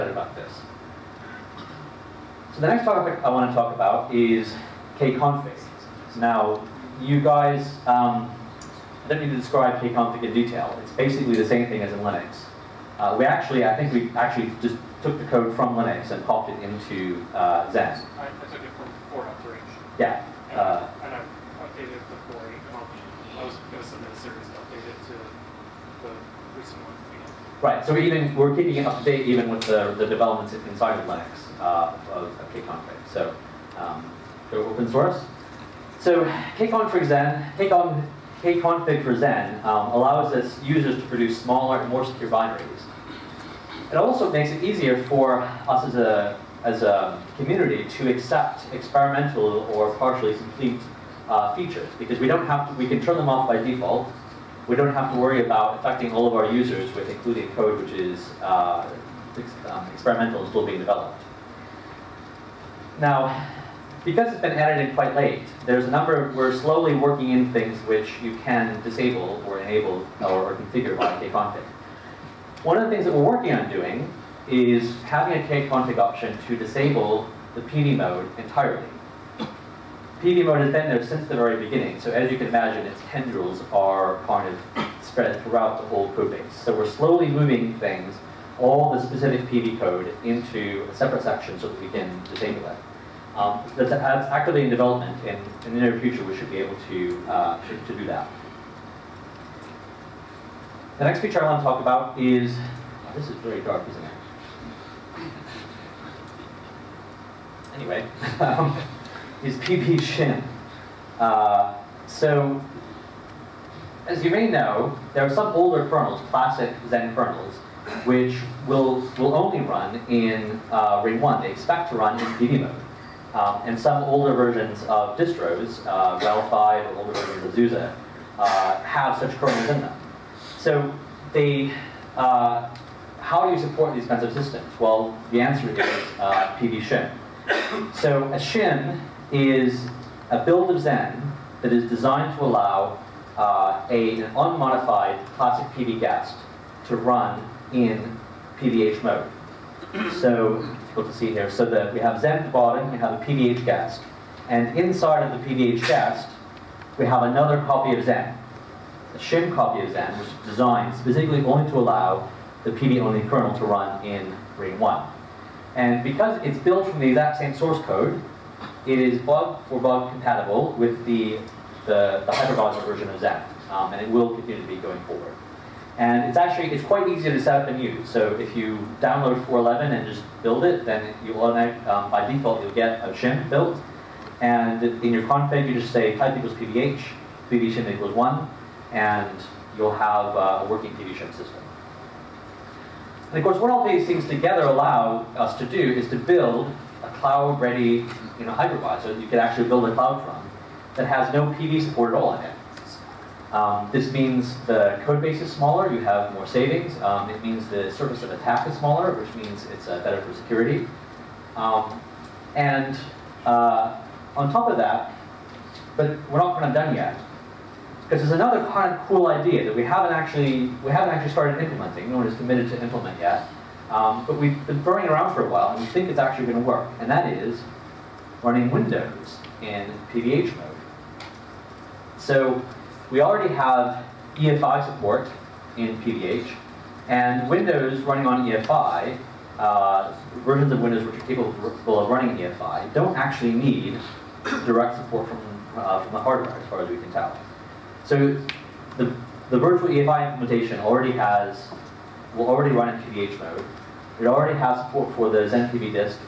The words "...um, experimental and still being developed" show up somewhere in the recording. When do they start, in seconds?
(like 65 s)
59 s.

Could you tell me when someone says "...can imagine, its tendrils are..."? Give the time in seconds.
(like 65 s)
82 s.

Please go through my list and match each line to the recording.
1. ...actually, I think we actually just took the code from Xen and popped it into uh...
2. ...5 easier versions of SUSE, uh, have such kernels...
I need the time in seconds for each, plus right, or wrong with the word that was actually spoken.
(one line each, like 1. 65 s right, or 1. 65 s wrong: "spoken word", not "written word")
1. 13 s wrong: "Linux", not "Xen"
2. 126 s wrong: "older", not "easier".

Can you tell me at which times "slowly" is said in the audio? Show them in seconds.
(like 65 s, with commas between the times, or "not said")
66 s, 86 s.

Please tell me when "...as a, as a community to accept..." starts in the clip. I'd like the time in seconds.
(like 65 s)
45 s.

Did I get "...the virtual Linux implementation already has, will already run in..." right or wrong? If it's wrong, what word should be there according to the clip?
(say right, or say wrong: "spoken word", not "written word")
wrong: "EFI", not "Linux".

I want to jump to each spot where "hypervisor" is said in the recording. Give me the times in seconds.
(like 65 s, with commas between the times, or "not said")
172 s, 198 s.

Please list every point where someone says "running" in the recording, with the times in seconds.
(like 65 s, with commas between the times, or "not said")
228 s, 238 s, 242 s.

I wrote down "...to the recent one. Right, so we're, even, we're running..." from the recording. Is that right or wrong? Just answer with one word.
wrong.